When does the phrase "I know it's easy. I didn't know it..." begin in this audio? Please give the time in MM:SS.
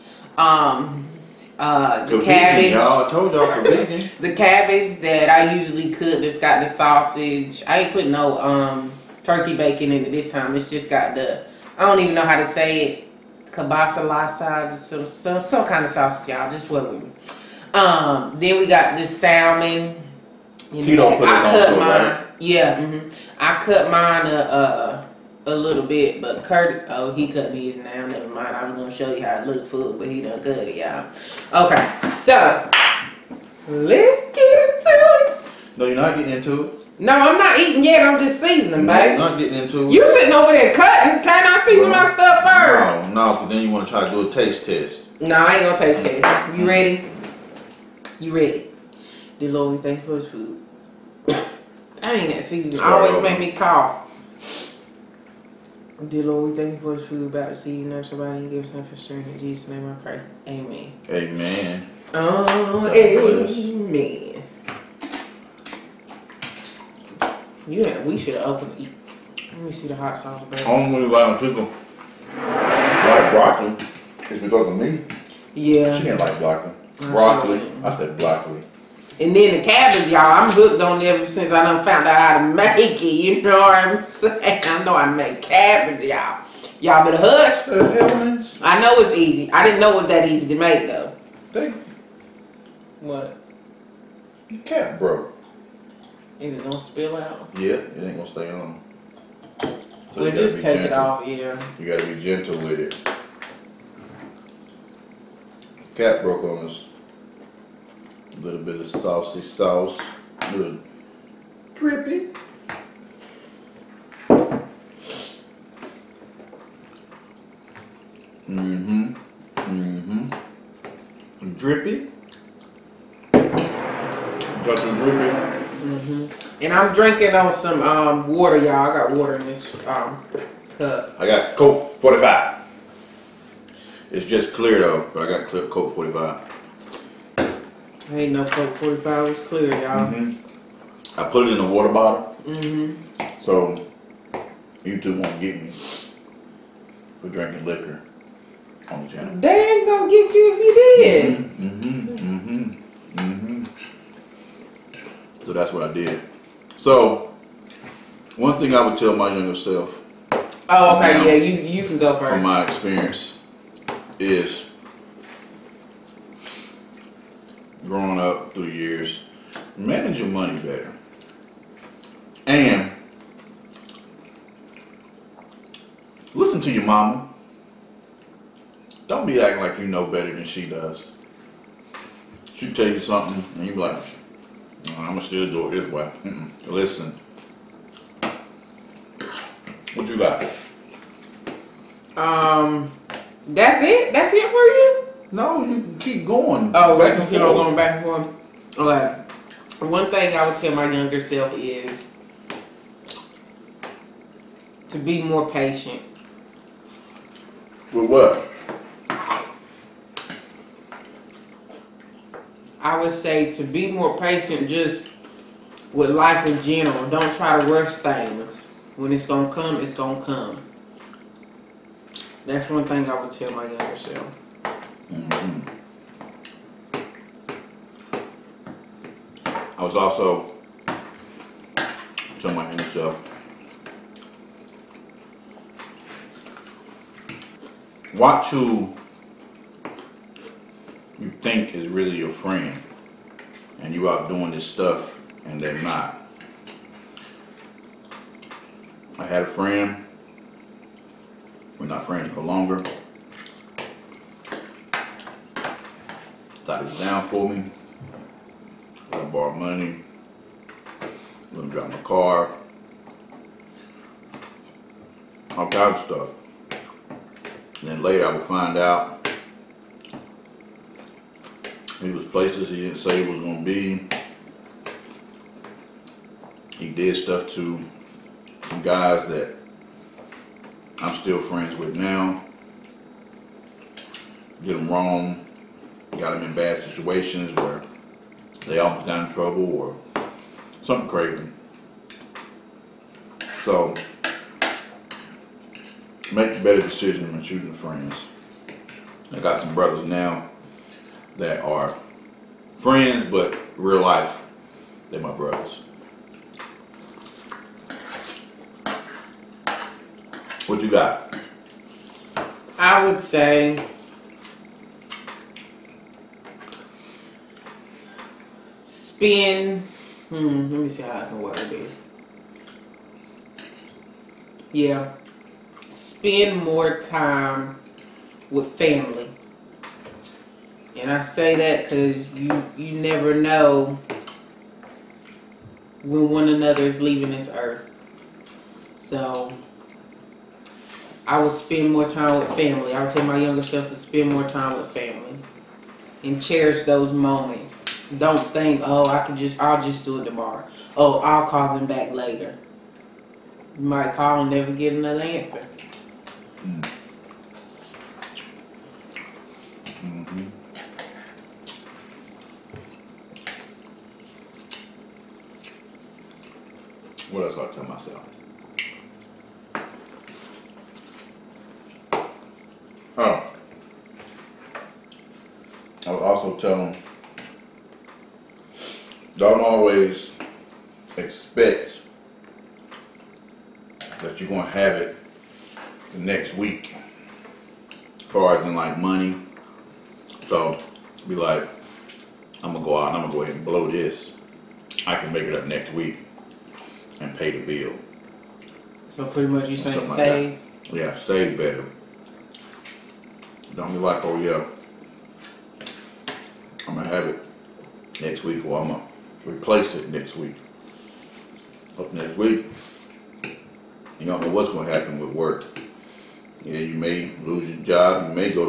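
01:28.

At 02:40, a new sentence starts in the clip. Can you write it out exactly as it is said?
Oh, okay, now, yeah, you you can go first.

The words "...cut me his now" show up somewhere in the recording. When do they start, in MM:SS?
00:27.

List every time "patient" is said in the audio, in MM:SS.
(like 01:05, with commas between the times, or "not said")
03:25, 03:34.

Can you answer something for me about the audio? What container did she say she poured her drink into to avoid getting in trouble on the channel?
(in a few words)
water bottle.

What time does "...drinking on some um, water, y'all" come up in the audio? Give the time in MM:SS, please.
02:06.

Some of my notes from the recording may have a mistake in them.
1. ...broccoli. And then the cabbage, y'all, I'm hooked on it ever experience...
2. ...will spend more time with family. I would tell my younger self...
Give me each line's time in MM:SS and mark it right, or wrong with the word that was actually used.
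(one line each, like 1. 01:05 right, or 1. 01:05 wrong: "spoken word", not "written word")
1. 01:18 wrong: "since", not "experience"
2. 05:41 right.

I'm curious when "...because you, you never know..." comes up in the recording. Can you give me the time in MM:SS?
05:31.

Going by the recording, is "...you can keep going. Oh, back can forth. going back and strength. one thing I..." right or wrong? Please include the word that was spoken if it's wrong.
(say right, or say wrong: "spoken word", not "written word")
wrong: "forth", not "strength".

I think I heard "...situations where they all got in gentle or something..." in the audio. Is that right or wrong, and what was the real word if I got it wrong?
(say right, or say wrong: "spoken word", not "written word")
wrong: "trouble", not "gentle".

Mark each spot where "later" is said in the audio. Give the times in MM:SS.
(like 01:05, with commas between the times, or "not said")
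04:28, 05:52.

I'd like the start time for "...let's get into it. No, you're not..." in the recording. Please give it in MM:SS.
00:33.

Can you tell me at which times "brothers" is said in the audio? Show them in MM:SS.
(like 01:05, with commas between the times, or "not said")
04:59, 05:05.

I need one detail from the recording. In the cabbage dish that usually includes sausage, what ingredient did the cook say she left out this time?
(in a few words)
turkey bacon.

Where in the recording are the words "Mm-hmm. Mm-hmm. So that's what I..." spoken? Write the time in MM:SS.
02:32.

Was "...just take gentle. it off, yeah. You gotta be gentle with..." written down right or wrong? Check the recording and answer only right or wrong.
right.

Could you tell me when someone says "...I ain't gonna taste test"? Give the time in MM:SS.
00:45.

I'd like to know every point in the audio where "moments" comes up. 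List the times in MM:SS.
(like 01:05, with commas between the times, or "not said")
05:47.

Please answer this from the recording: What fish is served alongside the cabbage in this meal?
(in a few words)
salmon.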